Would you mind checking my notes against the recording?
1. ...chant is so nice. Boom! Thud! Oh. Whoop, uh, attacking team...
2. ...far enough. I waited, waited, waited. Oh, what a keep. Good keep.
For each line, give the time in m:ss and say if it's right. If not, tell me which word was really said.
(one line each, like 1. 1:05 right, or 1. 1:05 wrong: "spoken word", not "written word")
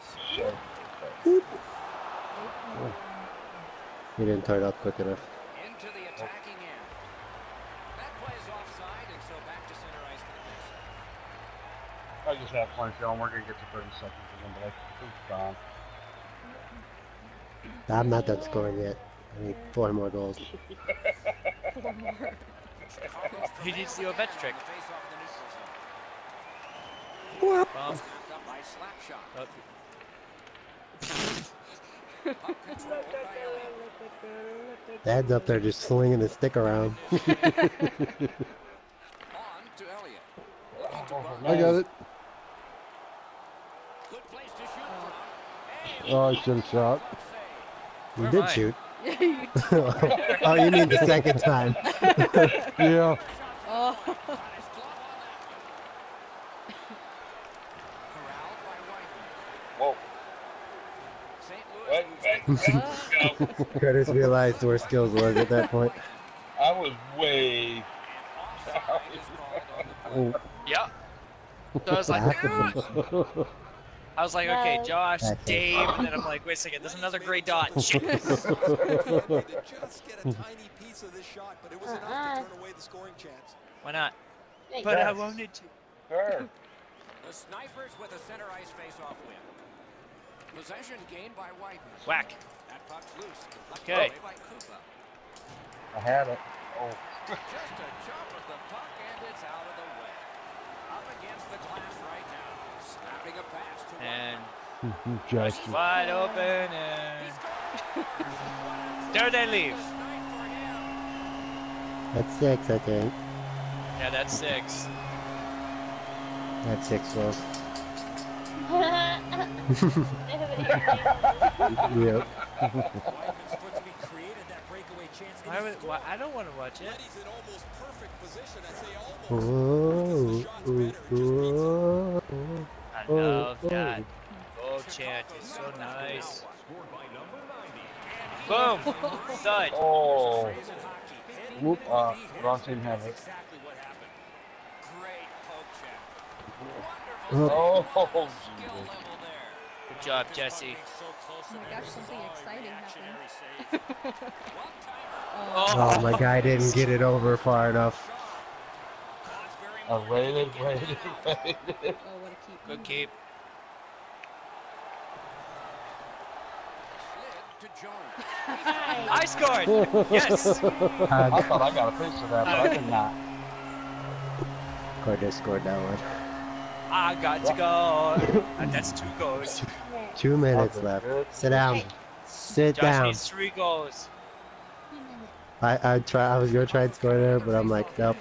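1. 2:14 wrong: "wrong", not "attacking"
2. 2:37 right.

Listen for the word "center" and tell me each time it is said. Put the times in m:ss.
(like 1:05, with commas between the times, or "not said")
0:09, 1:28.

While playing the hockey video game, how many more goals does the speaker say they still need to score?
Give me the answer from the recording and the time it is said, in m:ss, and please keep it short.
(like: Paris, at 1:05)
4, at 0:19.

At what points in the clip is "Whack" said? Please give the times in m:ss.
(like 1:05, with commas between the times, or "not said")
1:32.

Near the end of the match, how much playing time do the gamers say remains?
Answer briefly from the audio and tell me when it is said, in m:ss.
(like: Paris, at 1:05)
2 minutes, at 3:00.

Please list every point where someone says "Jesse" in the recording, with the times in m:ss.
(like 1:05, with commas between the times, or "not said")
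2:30.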